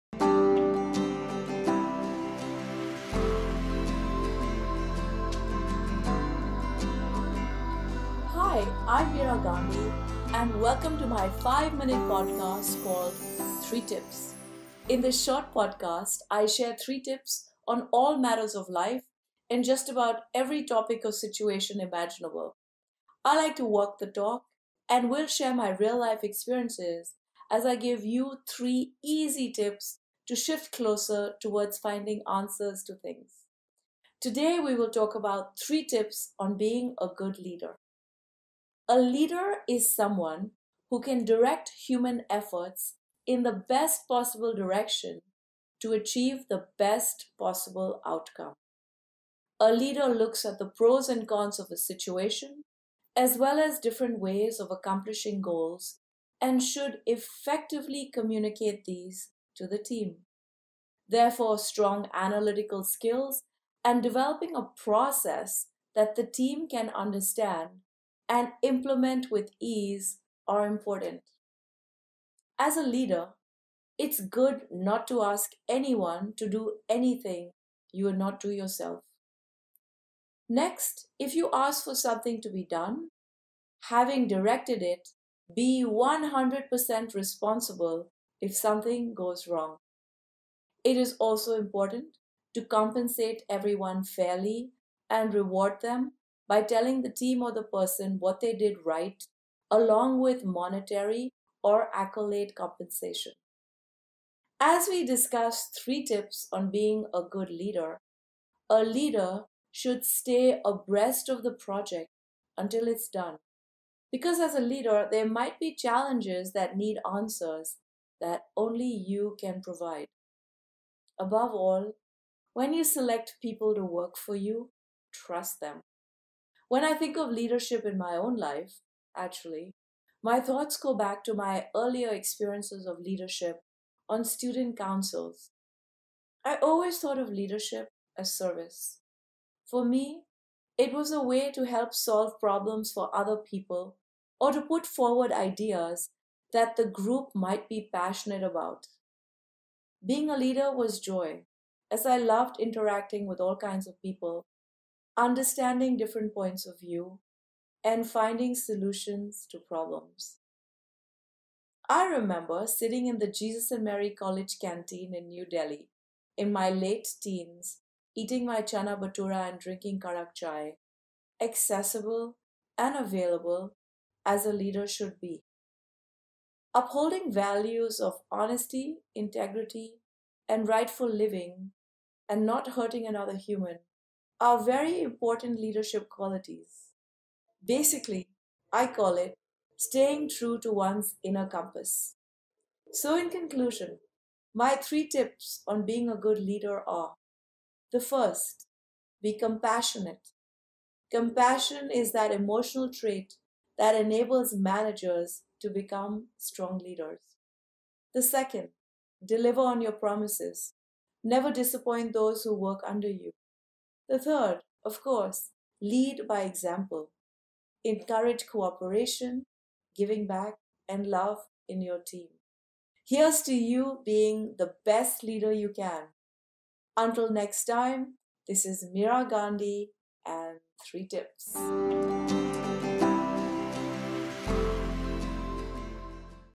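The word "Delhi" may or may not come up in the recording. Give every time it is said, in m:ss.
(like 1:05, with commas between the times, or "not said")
2:45.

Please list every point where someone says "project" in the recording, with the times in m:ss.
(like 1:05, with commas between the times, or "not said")
1:51.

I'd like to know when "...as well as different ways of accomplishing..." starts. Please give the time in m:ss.
0:53.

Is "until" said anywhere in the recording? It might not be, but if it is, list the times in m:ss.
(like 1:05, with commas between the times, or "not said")
1:52, 3:46.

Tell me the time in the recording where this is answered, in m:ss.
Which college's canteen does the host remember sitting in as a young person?
2:43.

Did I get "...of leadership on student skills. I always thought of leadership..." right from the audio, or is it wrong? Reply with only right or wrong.
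wrong.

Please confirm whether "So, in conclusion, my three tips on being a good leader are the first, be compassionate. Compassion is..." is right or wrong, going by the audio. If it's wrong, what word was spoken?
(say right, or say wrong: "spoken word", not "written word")
right.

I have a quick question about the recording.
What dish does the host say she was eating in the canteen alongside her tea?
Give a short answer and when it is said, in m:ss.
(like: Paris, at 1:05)
chana bhatura, at 2:48.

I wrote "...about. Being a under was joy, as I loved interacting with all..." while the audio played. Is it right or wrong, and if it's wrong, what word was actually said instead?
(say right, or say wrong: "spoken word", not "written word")
wrong: "leader", not "under".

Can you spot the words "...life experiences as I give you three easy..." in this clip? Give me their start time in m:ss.
0:26.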